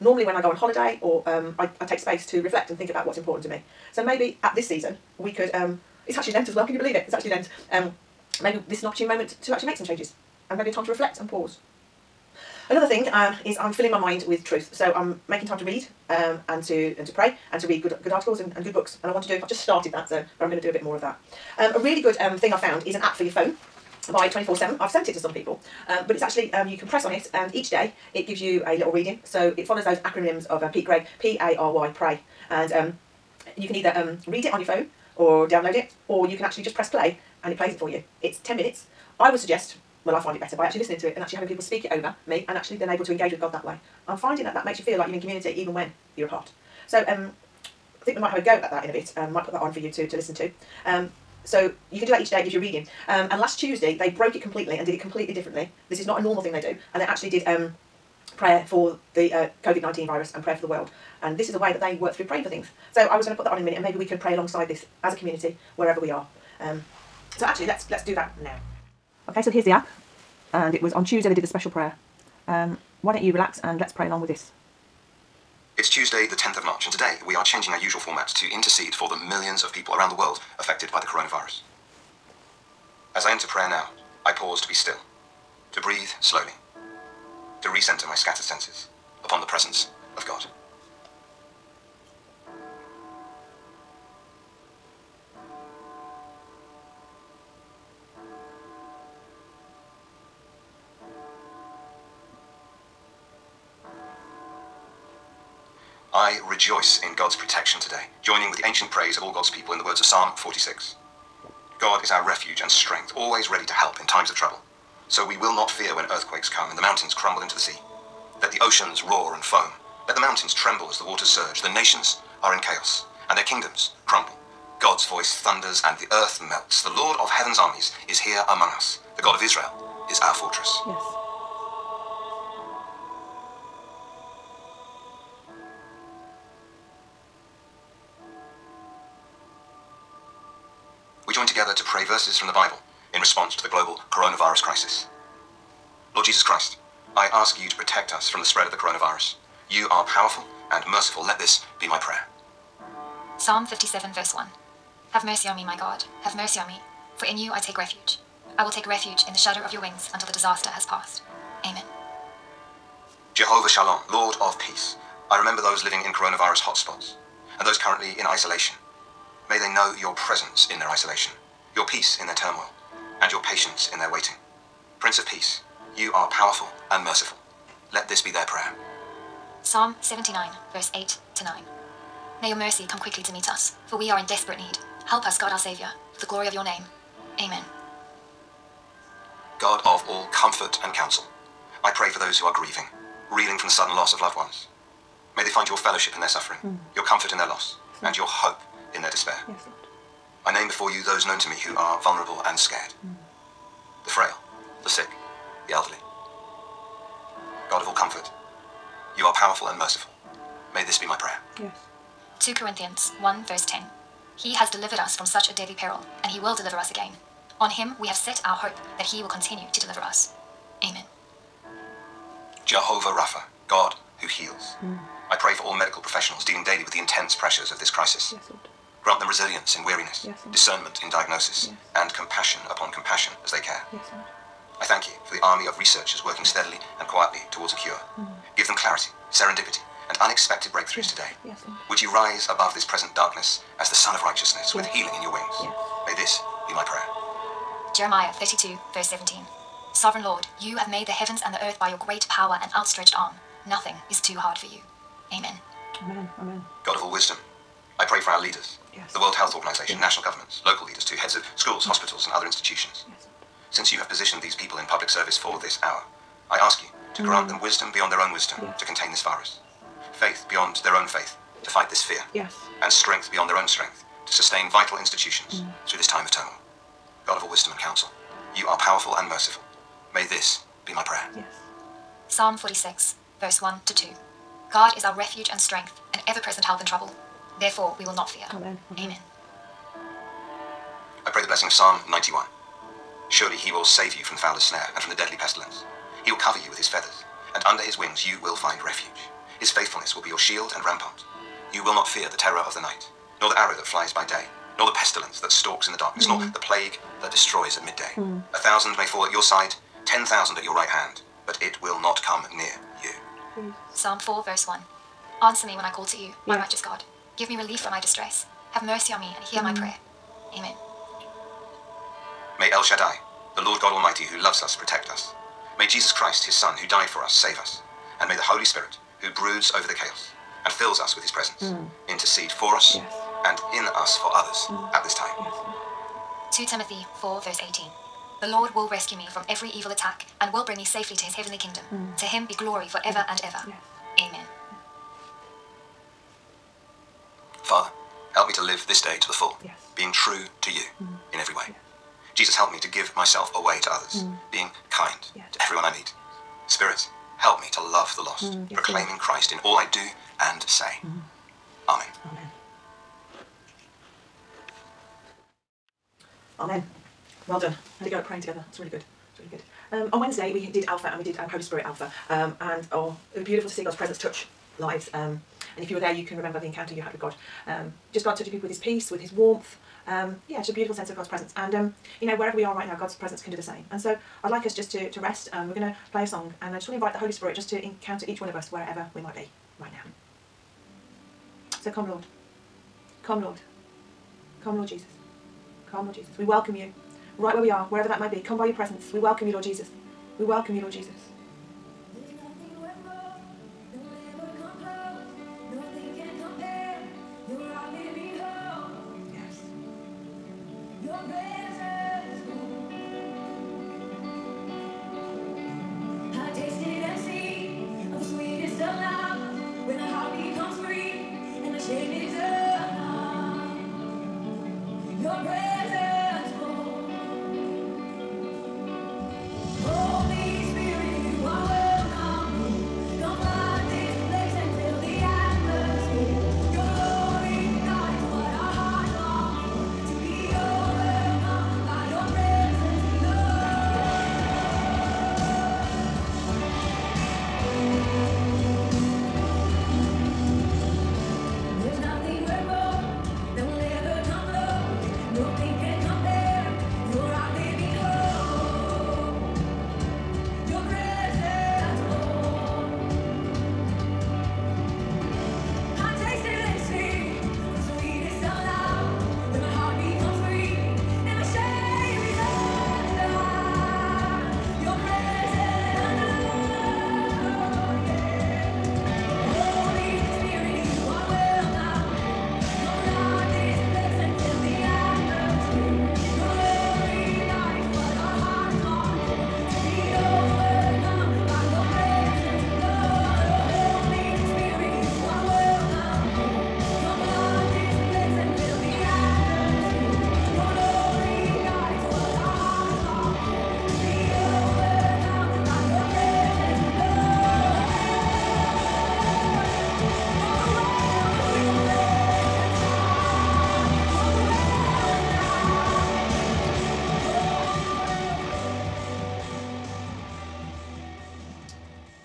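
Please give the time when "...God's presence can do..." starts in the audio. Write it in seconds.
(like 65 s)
382 s.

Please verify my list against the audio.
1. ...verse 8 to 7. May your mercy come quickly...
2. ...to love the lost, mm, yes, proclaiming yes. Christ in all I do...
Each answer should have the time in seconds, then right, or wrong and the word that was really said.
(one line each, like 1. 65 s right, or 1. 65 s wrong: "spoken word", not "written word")
1. 180 s wrong: "9", not "7"
2. 357 s right.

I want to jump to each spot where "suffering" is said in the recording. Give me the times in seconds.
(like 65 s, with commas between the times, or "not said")
196 s.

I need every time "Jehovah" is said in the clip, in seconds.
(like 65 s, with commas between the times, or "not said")
163 s, 222 s.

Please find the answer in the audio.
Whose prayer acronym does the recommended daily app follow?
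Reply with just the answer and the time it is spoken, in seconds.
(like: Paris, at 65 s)
Pete Greig, at 30 s.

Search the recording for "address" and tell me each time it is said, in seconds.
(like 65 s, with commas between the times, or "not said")
not said.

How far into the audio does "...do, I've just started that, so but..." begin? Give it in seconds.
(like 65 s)
19 s.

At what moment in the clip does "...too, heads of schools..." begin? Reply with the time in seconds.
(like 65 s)
261 s.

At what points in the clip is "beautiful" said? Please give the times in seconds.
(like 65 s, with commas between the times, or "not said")
373 s, 380 s.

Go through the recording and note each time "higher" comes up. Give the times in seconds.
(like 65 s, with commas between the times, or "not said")
not said.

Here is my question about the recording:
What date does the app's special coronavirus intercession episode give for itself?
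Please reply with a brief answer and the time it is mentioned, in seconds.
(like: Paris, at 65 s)
Tuesday, 10 March, at 75 s.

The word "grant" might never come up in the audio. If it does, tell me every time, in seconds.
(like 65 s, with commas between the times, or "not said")
229 s, 267 s.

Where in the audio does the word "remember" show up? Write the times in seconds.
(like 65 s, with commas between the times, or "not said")
165 s, 376 s.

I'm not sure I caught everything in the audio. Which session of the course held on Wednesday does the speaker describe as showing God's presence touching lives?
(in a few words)
Holy Spirit Alpha.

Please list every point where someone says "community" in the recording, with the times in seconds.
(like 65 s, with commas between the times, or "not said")
45 s, 65 s.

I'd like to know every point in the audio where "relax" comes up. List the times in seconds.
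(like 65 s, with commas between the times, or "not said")
73 s.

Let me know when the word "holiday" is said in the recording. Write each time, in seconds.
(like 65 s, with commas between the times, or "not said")
0 s.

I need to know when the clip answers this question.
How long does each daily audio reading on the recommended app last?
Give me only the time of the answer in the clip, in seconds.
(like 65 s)
38 s.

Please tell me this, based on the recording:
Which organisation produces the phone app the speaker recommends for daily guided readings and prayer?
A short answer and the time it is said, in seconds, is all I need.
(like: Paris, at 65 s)
24-7, at 24 s.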